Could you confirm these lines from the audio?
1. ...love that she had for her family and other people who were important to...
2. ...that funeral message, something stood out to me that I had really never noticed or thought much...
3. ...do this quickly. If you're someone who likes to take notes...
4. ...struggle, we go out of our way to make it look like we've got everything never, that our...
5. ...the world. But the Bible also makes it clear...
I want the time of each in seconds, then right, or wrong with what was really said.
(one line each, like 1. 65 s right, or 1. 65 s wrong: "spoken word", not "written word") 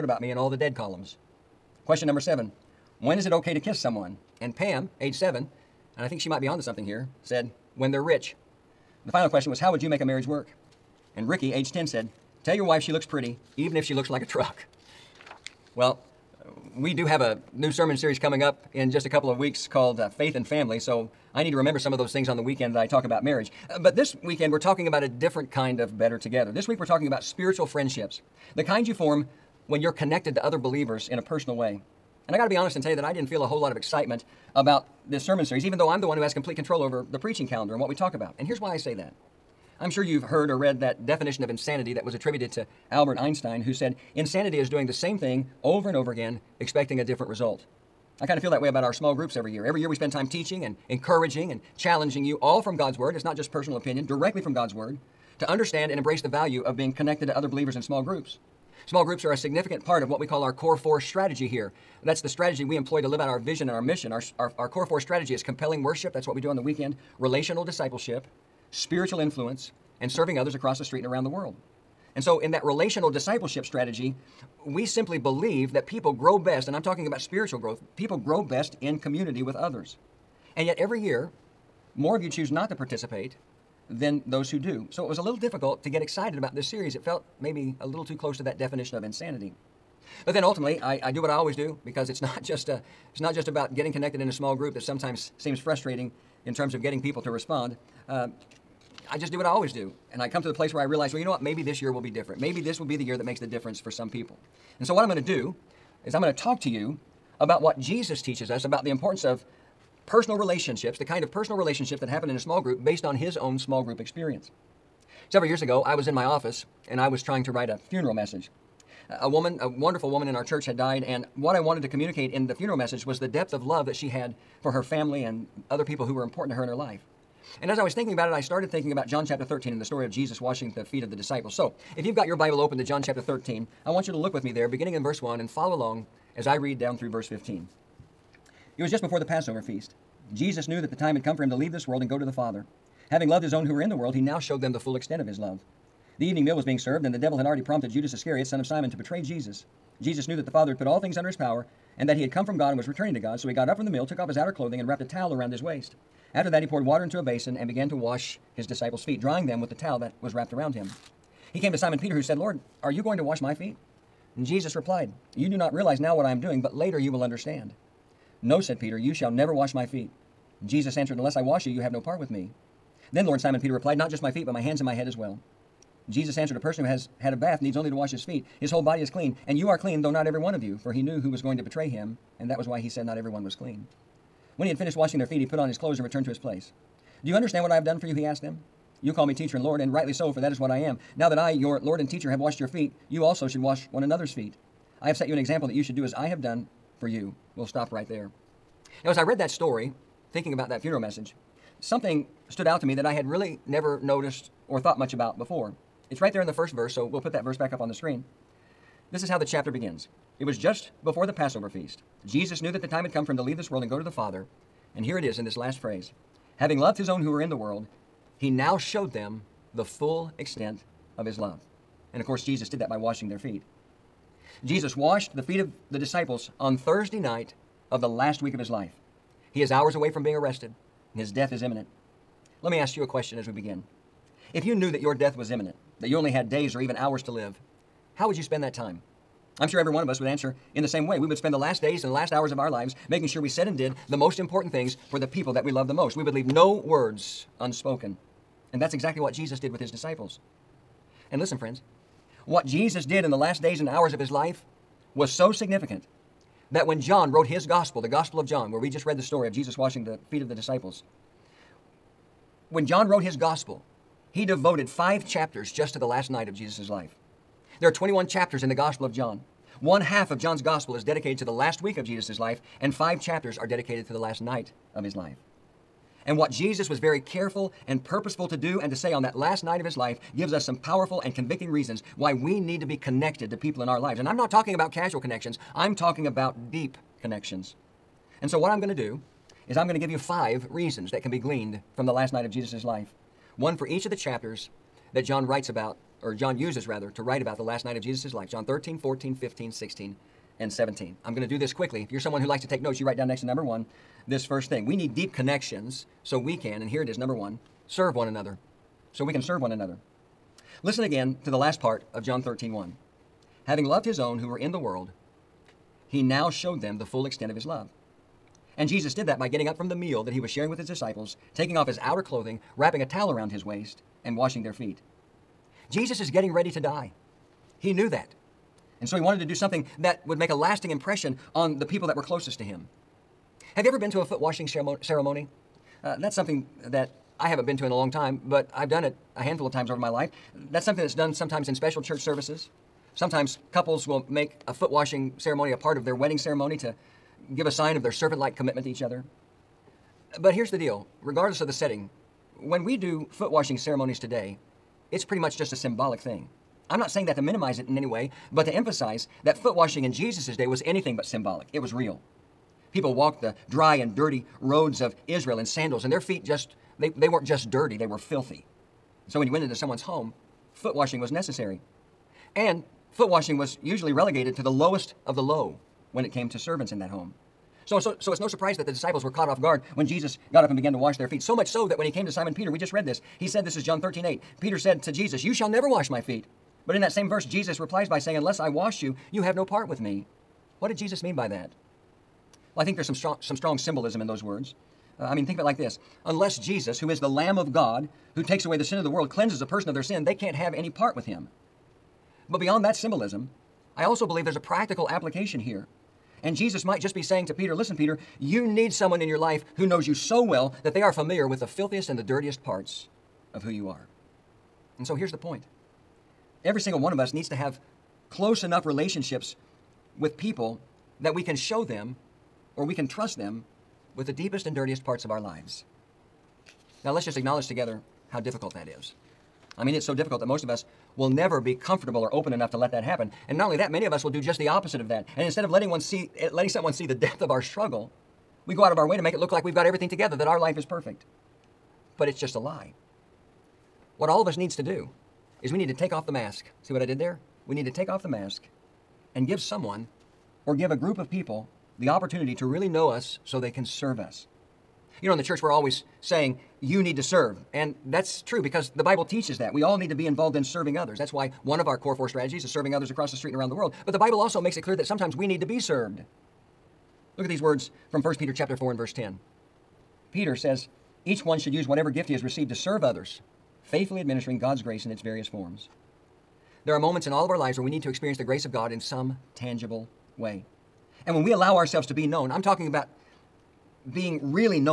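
1. 123 s right
2. 200 s right
3. 301 s right
4. 437 s wrong: "together", not "never"
5. 463 s right.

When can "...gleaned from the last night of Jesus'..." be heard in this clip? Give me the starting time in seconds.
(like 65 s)
291 s.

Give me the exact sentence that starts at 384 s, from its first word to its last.
Peter said to Jesus, You shall never wash my feet.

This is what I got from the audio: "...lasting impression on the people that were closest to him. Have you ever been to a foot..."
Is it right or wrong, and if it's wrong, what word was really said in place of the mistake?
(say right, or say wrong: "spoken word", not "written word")
right.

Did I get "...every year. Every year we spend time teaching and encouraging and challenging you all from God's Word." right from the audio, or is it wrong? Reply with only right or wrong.
right.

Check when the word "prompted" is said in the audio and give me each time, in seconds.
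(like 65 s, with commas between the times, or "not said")
147 s.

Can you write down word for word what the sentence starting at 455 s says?
You know, in the church, we're always saying, you need to serve.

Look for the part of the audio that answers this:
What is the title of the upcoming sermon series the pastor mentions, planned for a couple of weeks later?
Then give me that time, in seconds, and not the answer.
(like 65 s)
20 s.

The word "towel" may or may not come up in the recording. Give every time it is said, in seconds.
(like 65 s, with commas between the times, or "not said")
155 s, 159 s, 323 s.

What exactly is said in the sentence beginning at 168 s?
No, said Peter, you shall never wash my feet.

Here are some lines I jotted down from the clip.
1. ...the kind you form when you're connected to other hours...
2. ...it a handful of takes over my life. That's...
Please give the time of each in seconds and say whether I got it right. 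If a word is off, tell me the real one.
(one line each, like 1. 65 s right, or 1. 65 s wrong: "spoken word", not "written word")
1. 28 s wrong: "believers", not "hours"
2. 339 s wrong: "times", not "takes".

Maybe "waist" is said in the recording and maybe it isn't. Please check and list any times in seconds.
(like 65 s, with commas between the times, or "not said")
155 s, 323 s.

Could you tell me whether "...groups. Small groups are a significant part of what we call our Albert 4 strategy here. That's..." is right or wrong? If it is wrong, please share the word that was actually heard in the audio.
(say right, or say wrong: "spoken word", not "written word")
wrong: "Core", not "Albert".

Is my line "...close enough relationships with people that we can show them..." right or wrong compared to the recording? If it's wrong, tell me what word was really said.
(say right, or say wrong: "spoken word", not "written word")
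right.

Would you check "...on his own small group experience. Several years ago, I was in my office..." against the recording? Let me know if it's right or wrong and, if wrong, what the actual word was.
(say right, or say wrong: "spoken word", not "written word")
right.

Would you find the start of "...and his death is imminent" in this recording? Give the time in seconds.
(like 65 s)
231 s.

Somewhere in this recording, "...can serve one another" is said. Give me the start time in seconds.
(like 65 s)
309 s.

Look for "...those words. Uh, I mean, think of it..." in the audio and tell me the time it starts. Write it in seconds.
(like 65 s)
394 s.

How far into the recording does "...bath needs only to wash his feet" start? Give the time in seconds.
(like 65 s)
177 s.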